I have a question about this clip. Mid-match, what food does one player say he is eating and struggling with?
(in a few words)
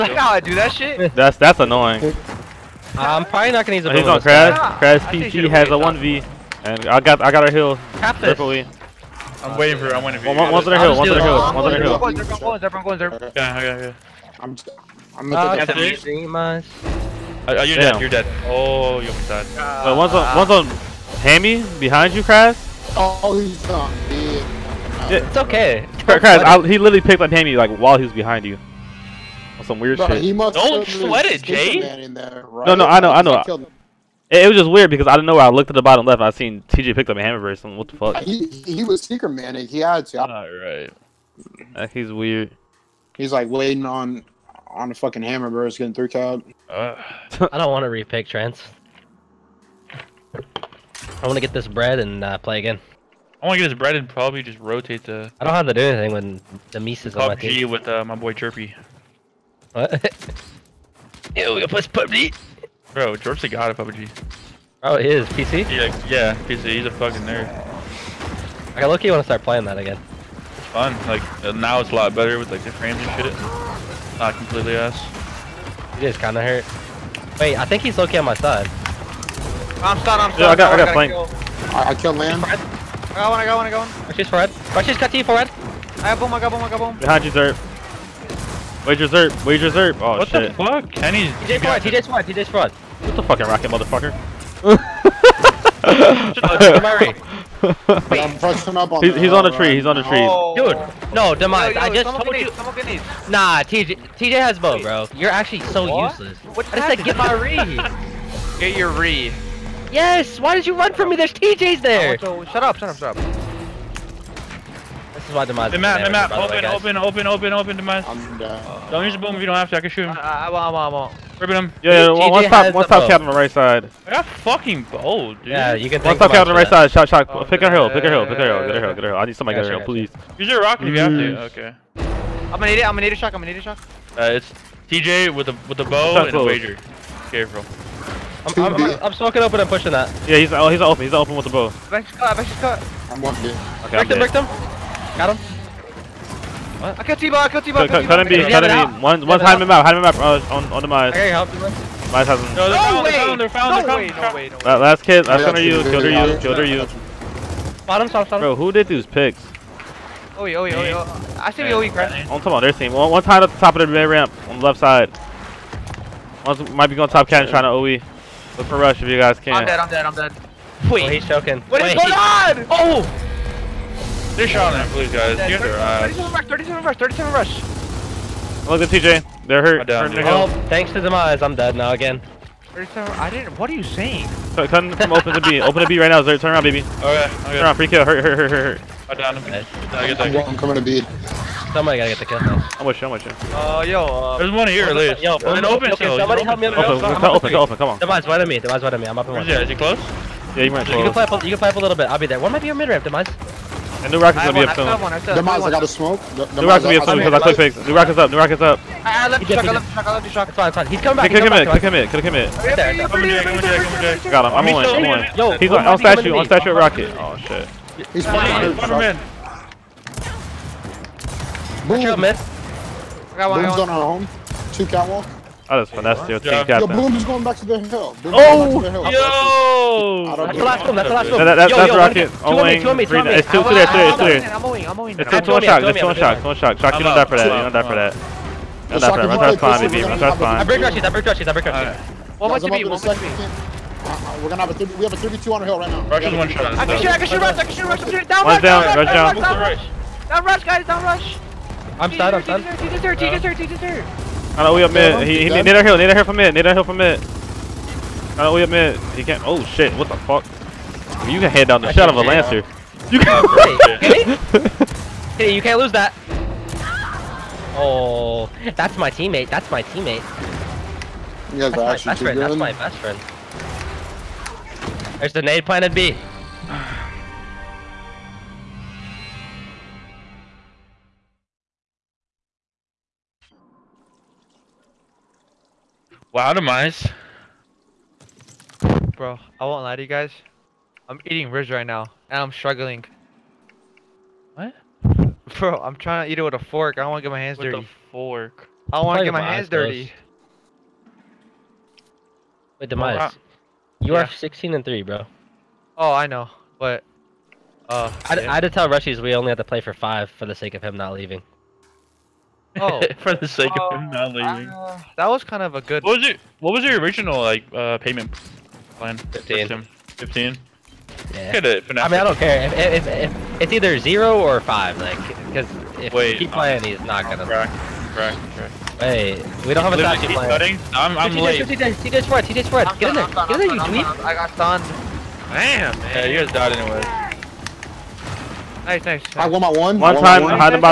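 Ribs.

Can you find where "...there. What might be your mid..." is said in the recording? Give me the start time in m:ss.
3:22.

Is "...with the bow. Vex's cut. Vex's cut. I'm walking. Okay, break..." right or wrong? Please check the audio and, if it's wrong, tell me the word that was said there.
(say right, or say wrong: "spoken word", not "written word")
right.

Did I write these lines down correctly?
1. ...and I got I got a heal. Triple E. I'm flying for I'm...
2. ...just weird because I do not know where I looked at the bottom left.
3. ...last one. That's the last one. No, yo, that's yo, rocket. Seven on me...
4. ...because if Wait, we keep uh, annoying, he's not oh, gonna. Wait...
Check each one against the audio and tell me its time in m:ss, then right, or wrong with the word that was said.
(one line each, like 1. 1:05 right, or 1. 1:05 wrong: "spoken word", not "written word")
1. 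0:06 wrong: "waiting", not "flying"
2. 0:34 right
3. 3:50 wrong: "Two", not "Seven"
4. 5:25 wrong: "playing", not "annoying".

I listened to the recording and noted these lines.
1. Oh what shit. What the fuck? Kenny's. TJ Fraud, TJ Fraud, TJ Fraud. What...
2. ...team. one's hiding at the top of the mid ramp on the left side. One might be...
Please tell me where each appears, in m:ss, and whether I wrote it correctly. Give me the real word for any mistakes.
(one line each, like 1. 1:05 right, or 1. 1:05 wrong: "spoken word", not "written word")
1. 1:29 right
2. 2:42 right.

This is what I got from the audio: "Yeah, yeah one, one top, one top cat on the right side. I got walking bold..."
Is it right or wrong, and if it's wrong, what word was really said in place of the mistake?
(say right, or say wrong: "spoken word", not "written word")
wrong: "fucking", not "walking".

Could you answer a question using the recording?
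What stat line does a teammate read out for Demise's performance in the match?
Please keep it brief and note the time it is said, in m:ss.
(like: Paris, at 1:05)
16 and 3, at 5:04.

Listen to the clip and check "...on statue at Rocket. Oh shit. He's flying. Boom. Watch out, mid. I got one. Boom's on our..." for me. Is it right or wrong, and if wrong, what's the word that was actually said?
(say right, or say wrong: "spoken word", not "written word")
right.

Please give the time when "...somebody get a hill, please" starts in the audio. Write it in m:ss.
2:09.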